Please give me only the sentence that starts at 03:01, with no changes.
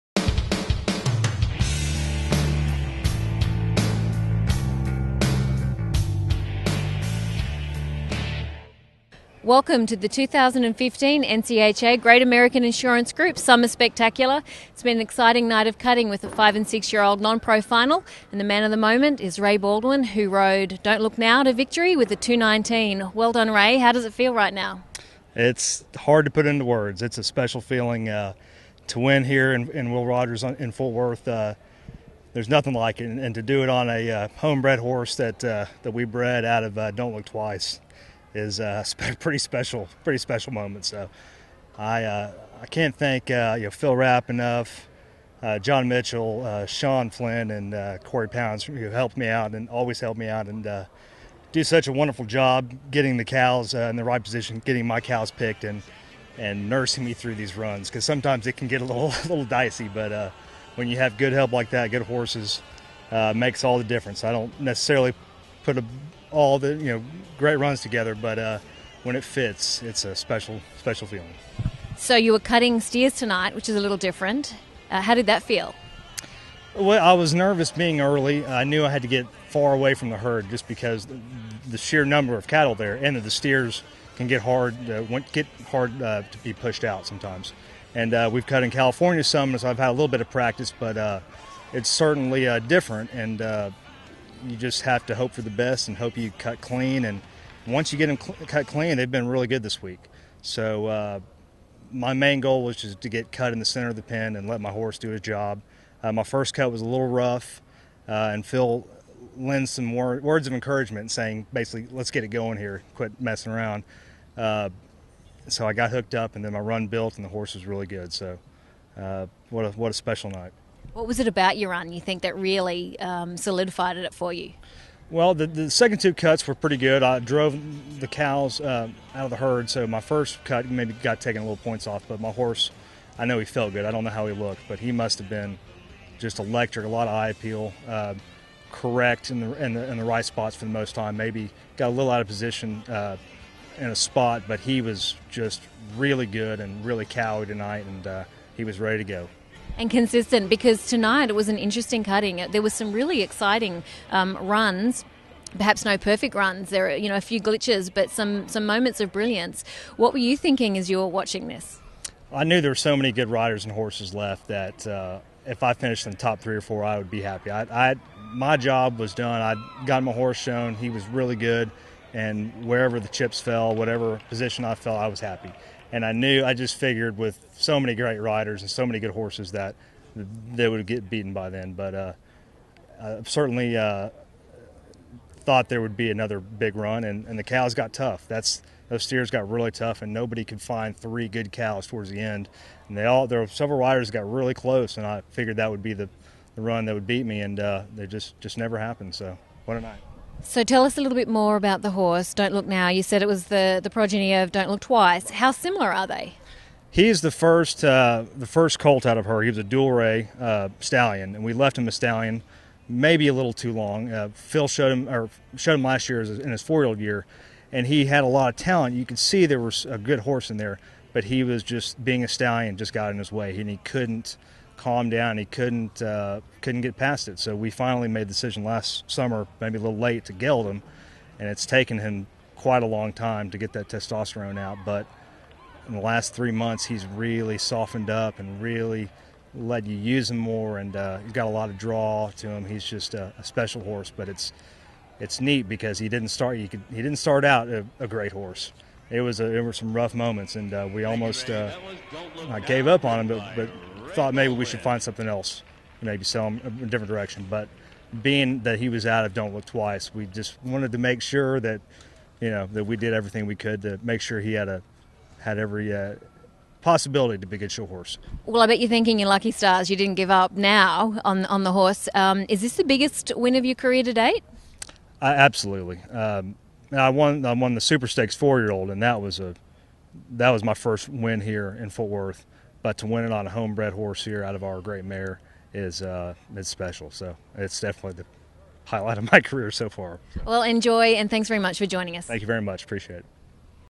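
But uh, I certainly uh, thought there would be another big run, and, and the cows got tough.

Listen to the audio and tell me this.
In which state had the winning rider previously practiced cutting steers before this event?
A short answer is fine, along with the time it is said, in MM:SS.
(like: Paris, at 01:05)
California, at 01:28.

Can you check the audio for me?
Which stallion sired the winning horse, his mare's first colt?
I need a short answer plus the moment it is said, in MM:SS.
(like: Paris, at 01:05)
Dual Rey, at 03:29.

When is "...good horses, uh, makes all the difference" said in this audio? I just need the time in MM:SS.
01:01.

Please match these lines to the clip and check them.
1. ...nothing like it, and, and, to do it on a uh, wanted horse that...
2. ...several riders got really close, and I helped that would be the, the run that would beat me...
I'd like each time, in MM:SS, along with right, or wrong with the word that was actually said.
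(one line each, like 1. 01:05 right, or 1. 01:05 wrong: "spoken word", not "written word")
1. 00:32 wrong: "homebred", not "wanted"
2. 03:13 wrong: "figured", not "helped".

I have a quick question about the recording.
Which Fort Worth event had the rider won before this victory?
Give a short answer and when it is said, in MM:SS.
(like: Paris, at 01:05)
Super Stakes four year old, at 04:37.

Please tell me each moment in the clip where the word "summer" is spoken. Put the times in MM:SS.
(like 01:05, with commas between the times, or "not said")
00:13, 03:49.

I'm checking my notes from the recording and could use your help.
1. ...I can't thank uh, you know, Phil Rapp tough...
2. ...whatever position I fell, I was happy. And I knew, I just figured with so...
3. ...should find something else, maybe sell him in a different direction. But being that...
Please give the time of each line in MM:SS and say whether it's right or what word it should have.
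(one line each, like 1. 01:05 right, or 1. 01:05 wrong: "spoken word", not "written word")
1. 00:42 wrong: "enough", not "tough"
2. 02:53 right
3. 04:14 right.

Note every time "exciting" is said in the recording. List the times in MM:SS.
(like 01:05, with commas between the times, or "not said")
00:15, 02:33.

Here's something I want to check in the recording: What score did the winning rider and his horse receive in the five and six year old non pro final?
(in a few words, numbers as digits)
219.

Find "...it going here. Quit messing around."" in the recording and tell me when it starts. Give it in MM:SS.
01:52.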